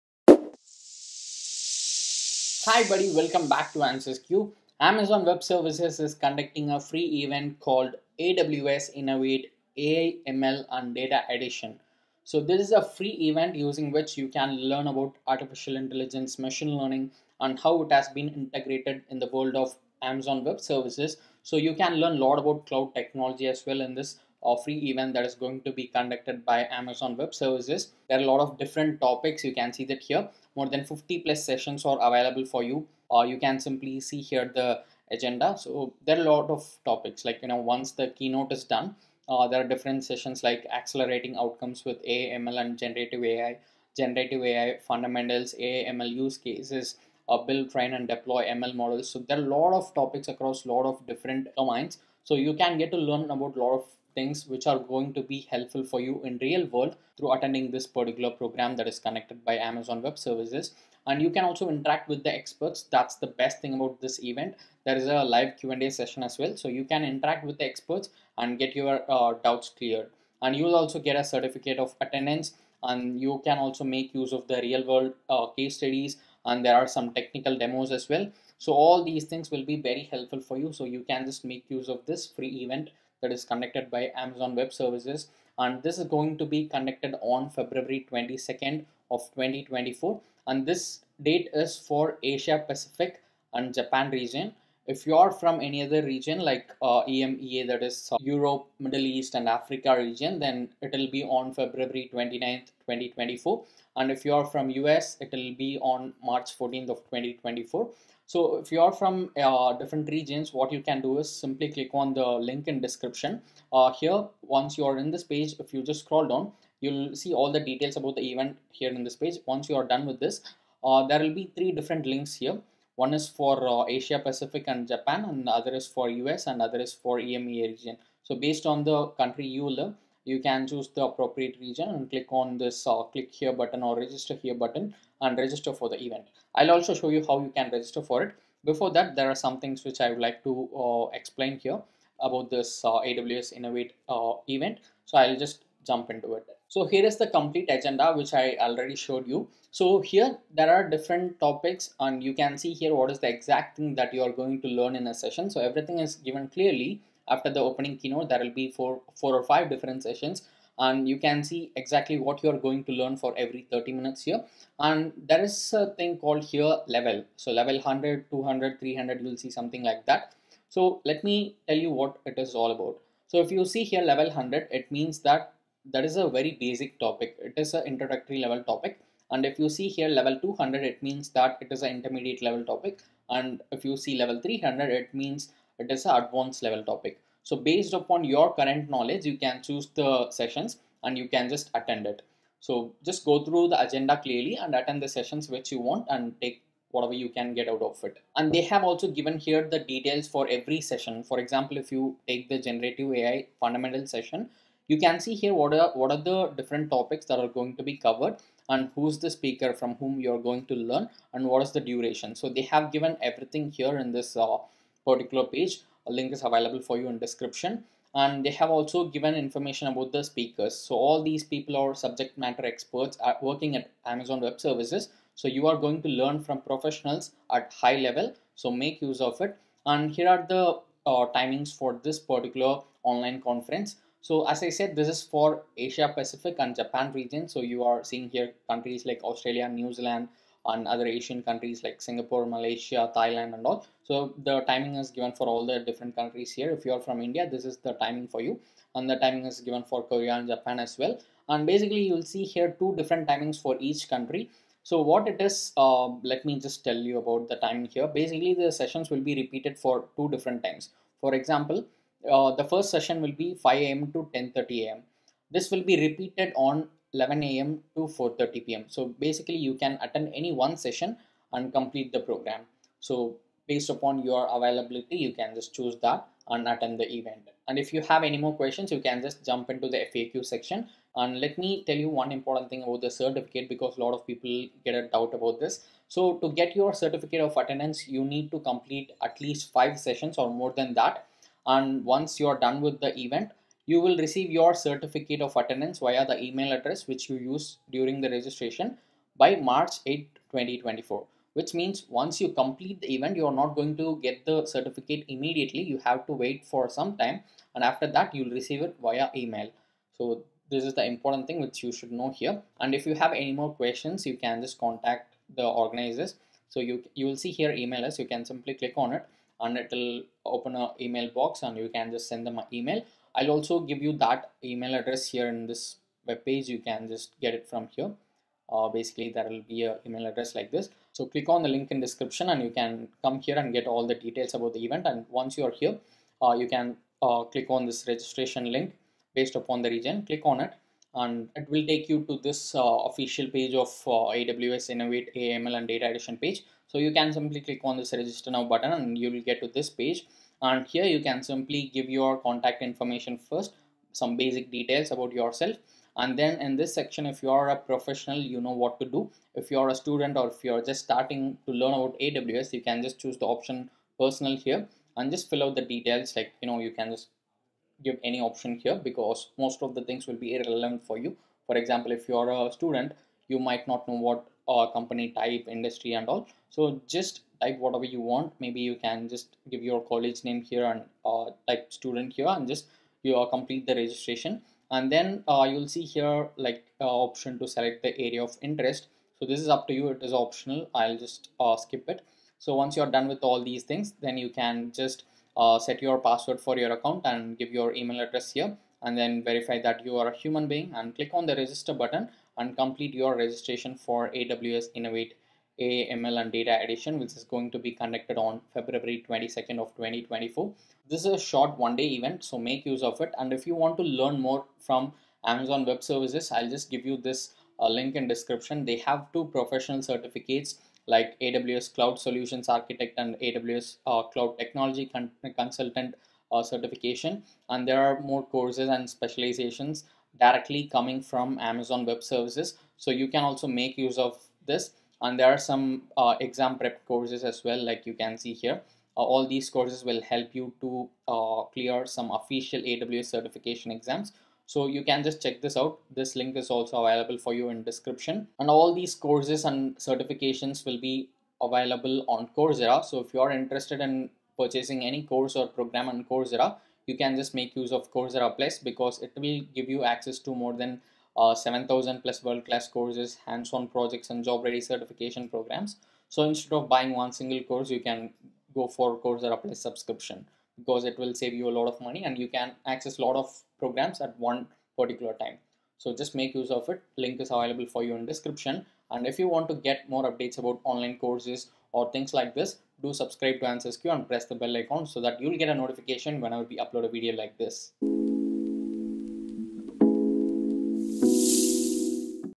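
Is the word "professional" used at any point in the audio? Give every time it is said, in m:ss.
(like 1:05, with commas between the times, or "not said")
3:46, 5:57, 6:59.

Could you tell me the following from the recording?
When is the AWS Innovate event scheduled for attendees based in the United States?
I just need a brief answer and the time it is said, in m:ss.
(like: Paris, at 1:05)
March 14th 2024, at 1:46.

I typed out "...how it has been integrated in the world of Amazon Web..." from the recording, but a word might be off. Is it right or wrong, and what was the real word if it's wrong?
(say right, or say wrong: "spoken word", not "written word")
right.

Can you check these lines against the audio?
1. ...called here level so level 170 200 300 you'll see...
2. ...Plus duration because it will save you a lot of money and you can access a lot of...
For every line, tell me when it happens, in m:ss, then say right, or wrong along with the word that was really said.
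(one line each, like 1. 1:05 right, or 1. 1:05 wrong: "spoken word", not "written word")
1. 2:46 wrong: "100", not "170"
2. 7:49 wrong: "subscription", not "duration".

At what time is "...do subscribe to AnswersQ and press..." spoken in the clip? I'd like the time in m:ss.
8:03.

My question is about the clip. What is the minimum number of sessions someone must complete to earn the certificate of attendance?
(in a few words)
5.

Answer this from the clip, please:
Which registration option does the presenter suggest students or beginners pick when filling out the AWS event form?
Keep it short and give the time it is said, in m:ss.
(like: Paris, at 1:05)
personal, at 6:03.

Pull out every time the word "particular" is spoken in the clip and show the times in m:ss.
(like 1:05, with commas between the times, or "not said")
0:57, 3:35, 3:52, 7:54.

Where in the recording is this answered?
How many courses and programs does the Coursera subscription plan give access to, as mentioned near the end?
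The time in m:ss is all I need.
7:41.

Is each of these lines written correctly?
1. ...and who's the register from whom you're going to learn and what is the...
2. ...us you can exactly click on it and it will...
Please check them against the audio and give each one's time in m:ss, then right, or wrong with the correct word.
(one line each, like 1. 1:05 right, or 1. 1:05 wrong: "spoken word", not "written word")
1. 3:28 wrong: "speaker", not "register"
2. 5:18 wrong: "simply", not "exactly".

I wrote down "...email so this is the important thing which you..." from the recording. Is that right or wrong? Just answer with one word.
right.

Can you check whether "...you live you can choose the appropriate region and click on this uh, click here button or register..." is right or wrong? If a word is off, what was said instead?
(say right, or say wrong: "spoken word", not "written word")
right.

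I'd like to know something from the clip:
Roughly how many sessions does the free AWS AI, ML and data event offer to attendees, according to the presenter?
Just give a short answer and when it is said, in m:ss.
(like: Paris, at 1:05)
50 plus, at 0:30.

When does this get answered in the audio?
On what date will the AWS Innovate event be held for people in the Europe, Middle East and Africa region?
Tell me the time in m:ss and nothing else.
1:41.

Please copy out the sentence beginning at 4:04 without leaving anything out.
So the timing is given for all the different countries here.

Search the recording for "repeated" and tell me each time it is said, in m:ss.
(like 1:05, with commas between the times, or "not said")
4:19, 4:25.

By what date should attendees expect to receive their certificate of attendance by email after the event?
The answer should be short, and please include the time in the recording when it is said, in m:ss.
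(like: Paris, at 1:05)
March 8 2024, at 4:59.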